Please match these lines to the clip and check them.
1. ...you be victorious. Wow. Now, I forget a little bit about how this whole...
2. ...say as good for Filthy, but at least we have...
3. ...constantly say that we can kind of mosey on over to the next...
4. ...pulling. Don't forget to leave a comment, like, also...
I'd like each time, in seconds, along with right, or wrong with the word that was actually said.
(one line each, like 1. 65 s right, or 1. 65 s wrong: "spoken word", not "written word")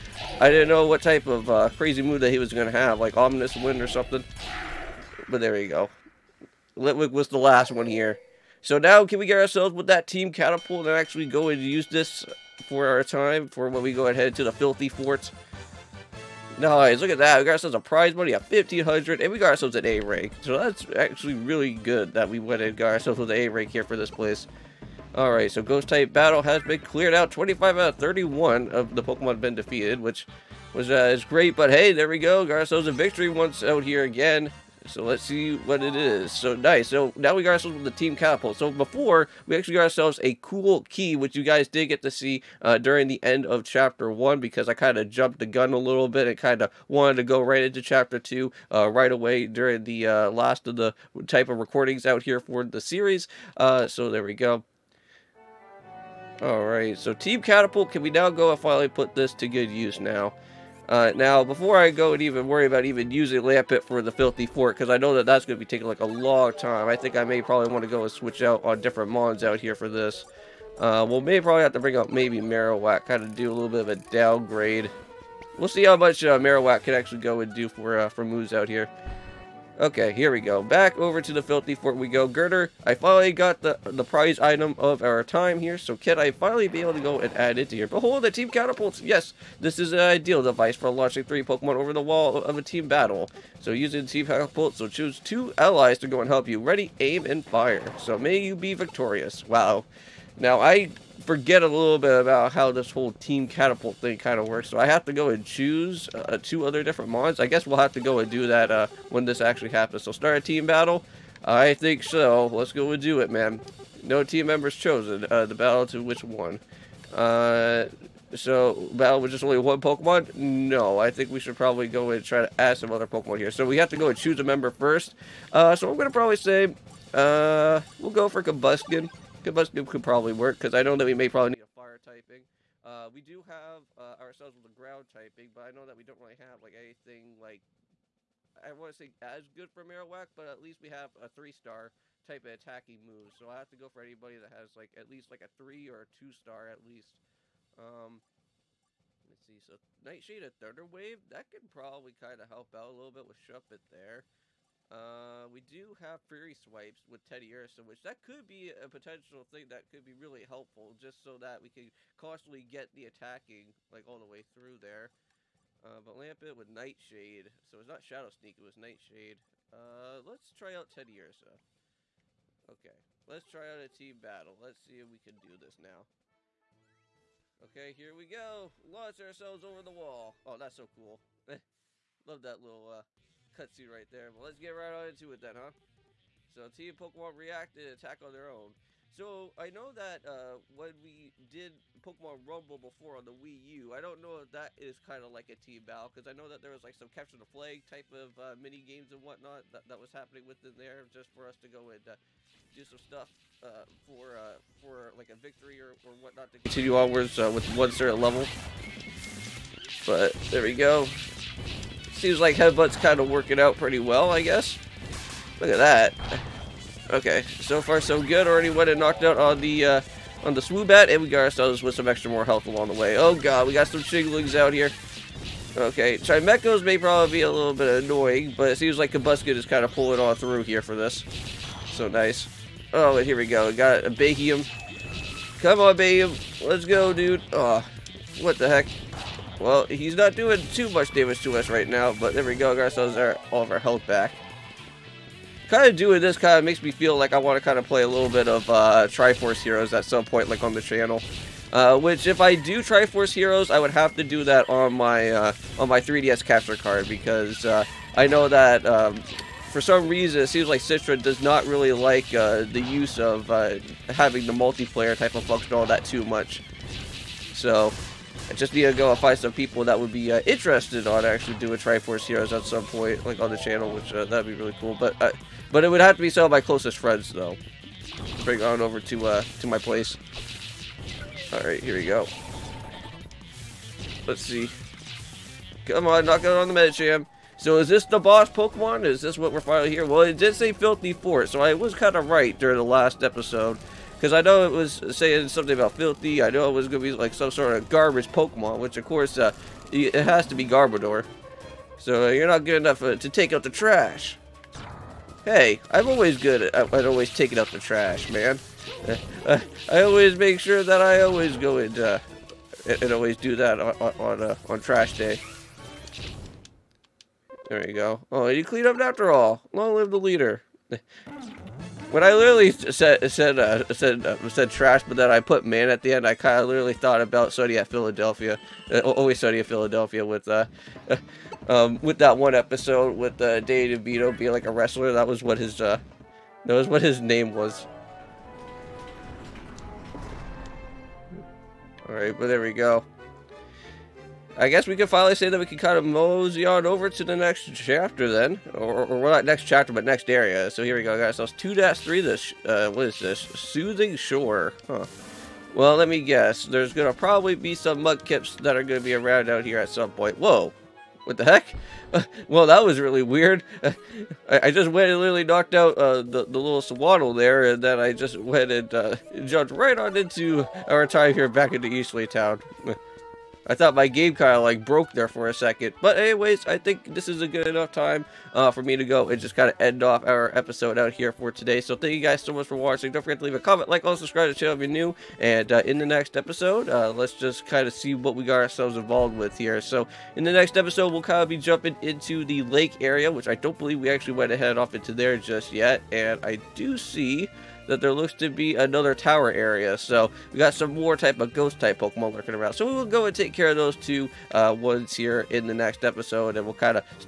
1. 98 s right
2. 138 s wrong: "Marowak", not "Filthy"
3. 345 s wrong: "finally", not "constantly"
4. 382 s wrong: "watching", not "pulling".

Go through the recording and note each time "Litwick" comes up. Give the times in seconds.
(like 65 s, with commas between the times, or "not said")
6 s.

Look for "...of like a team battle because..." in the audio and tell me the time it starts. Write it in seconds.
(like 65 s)
195 s.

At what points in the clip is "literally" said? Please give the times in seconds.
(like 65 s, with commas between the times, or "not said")
322 s, 326 s, 365 s.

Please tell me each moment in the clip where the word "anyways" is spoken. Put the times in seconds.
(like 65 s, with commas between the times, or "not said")
376 s.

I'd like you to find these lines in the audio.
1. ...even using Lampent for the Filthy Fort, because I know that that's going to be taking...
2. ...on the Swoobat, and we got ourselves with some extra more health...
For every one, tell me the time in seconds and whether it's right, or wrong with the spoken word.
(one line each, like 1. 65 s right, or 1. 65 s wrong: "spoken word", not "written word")
1. 62 s right
2. 220 s right.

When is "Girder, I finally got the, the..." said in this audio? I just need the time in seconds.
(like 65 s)
82 s.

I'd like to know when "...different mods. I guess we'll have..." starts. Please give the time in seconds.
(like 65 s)
106 s.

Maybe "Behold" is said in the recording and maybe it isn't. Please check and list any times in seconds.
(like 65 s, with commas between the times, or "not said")
87 s.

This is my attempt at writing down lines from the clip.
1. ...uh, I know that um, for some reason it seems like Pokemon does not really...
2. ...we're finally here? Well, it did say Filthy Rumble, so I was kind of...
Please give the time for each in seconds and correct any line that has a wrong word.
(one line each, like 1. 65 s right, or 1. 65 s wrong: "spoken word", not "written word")
1. 257 s wrong: "Citra", not "Pokemon"
2. 289 s wrong: "Fort", not "Rumble".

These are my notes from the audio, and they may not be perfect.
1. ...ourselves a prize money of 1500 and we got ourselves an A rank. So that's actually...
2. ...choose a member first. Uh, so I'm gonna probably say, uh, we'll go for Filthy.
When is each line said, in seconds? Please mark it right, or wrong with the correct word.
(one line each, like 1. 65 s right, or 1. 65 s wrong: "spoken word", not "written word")
1. 17 s right
2. 124 s wrong: "Combusken", not "Filthy".